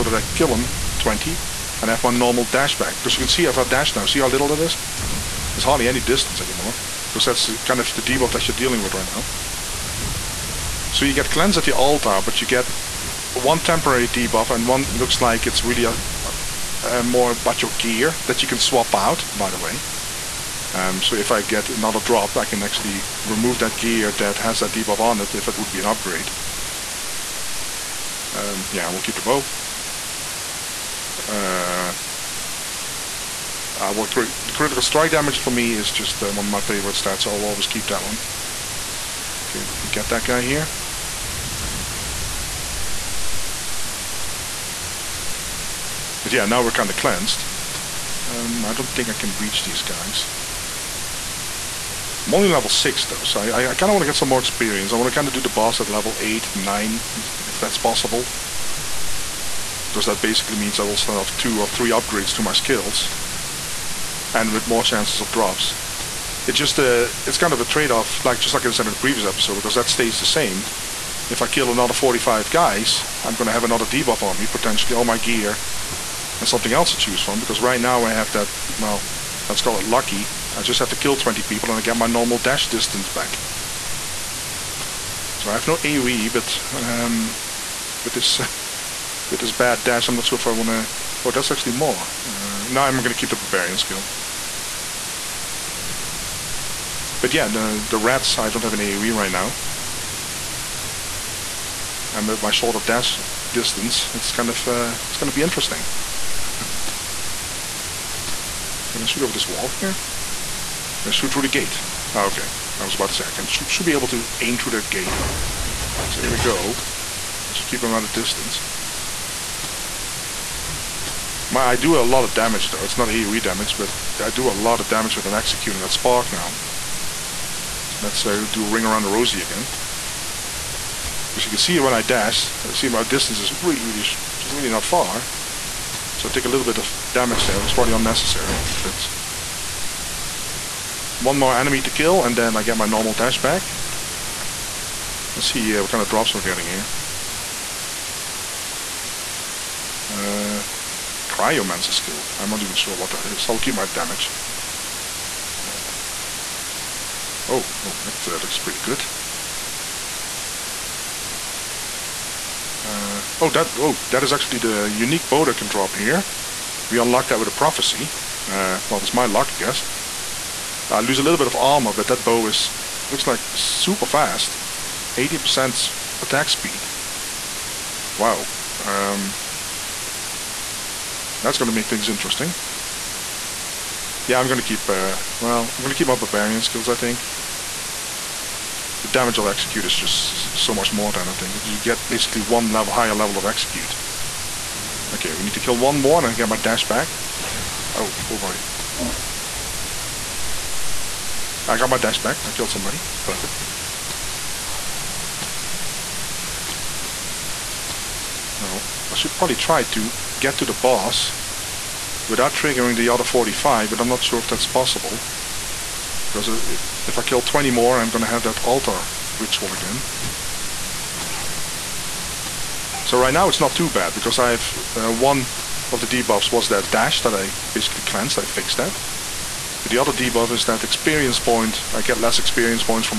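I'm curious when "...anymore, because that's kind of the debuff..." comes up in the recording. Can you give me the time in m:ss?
0:06.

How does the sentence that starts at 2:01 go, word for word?
My, I do a lot of damage though.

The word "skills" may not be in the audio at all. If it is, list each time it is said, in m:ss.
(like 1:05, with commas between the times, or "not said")
1:02, 1:33, 2:31, 3:06.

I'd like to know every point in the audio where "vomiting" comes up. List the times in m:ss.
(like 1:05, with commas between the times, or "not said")
not said.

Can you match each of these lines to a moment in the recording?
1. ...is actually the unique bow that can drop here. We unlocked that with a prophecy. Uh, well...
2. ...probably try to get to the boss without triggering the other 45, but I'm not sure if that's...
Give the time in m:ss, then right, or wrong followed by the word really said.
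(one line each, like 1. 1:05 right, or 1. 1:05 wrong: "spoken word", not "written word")
1. 2:44 right
2. 3:29 right.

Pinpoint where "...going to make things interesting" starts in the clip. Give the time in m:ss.
3:01.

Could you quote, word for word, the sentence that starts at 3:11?
You get basically one level higher level of execute.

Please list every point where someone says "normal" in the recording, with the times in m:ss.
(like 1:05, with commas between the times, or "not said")
0:02, 1:22, 2:22.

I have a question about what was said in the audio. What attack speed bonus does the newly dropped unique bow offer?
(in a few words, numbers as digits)
80%.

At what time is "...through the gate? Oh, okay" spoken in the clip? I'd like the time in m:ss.
1:51.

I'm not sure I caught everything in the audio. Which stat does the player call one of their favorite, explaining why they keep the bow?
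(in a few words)
Critical strike damage.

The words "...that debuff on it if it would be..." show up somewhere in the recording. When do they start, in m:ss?
0:24.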